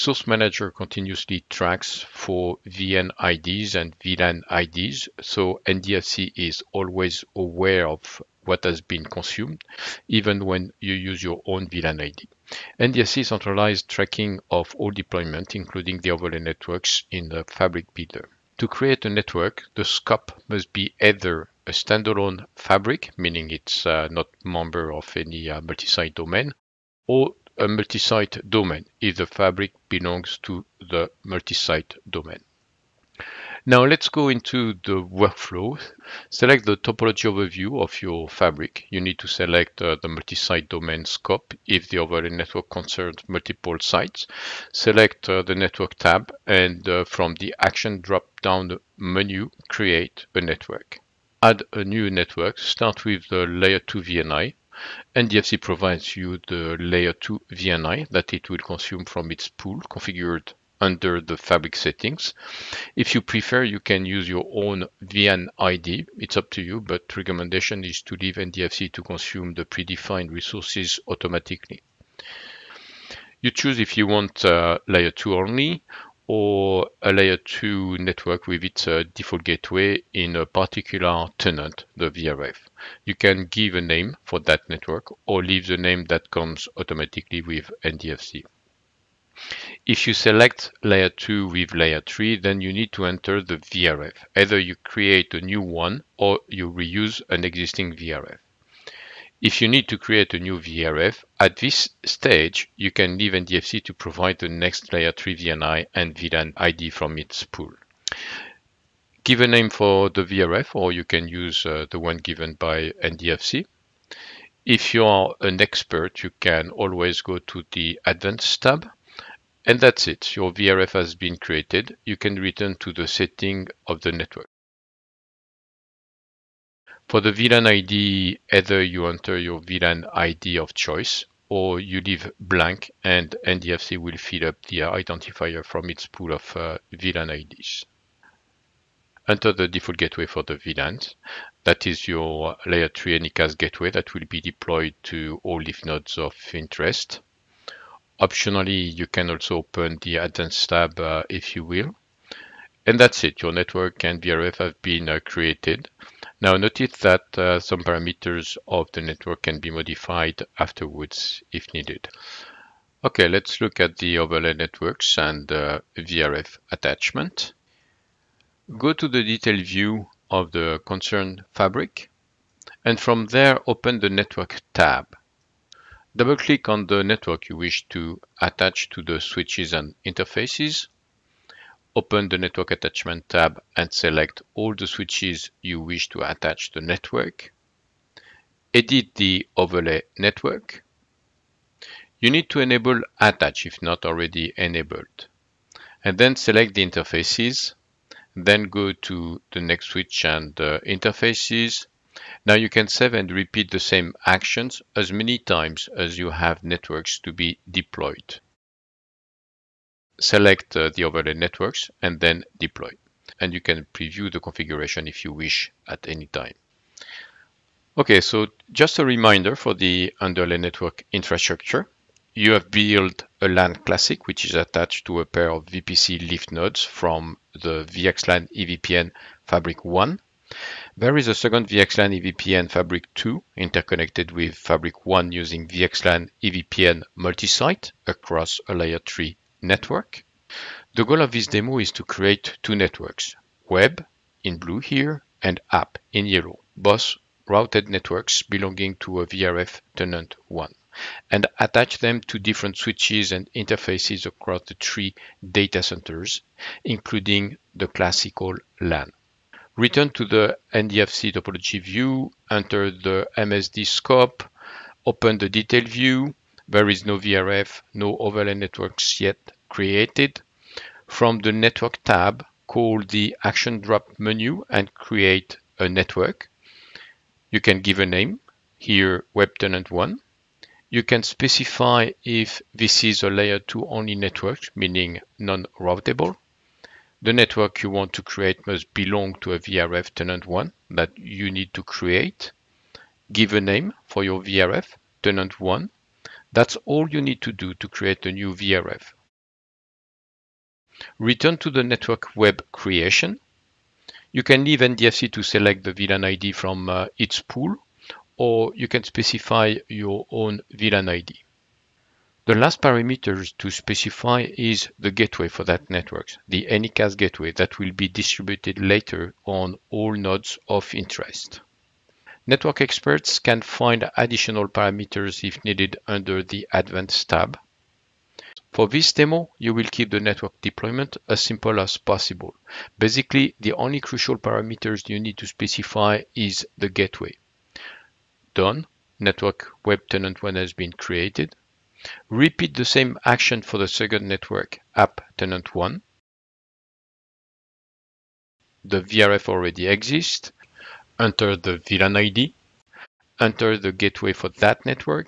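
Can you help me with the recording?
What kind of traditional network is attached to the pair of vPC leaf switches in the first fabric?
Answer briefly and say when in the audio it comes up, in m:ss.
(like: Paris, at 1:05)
LAN classic, at 3:43.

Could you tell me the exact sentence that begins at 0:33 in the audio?
Now let's go into the workflow.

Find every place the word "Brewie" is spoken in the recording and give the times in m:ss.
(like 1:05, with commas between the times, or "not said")
not said.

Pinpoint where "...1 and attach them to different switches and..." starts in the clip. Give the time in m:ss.
4:10.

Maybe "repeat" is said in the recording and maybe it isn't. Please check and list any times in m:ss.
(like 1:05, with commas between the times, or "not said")
3:23, 5:42.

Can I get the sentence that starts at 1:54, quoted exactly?
If you are an expert, you can always go to the Advanced tab.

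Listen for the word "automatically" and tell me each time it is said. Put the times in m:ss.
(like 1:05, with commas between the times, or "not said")
1:11, 1:26.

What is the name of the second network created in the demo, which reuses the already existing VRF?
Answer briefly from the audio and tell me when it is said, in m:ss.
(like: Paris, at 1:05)
app tenant 1, at 5:44.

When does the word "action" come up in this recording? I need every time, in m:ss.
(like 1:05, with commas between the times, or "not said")
0:47, 3:24, 4:33, 5:43.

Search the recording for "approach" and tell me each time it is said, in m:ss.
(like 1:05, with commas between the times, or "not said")
not said.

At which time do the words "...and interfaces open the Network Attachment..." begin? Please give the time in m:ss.
2:59.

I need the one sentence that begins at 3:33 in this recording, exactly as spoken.
And you can preview the configuration if you wish at any time.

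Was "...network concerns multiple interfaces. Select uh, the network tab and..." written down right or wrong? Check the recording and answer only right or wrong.
wrong.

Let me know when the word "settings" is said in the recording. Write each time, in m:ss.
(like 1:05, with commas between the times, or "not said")
1:01, 2:03.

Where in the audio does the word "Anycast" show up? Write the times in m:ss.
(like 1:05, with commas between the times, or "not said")
2:23, 5:16.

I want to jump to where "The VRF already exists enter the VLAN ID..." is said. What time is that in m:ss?
5:48.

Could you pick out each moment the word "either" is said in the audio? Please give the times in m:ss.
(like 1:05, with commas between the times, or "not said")
0:20, 1:34, 2:08.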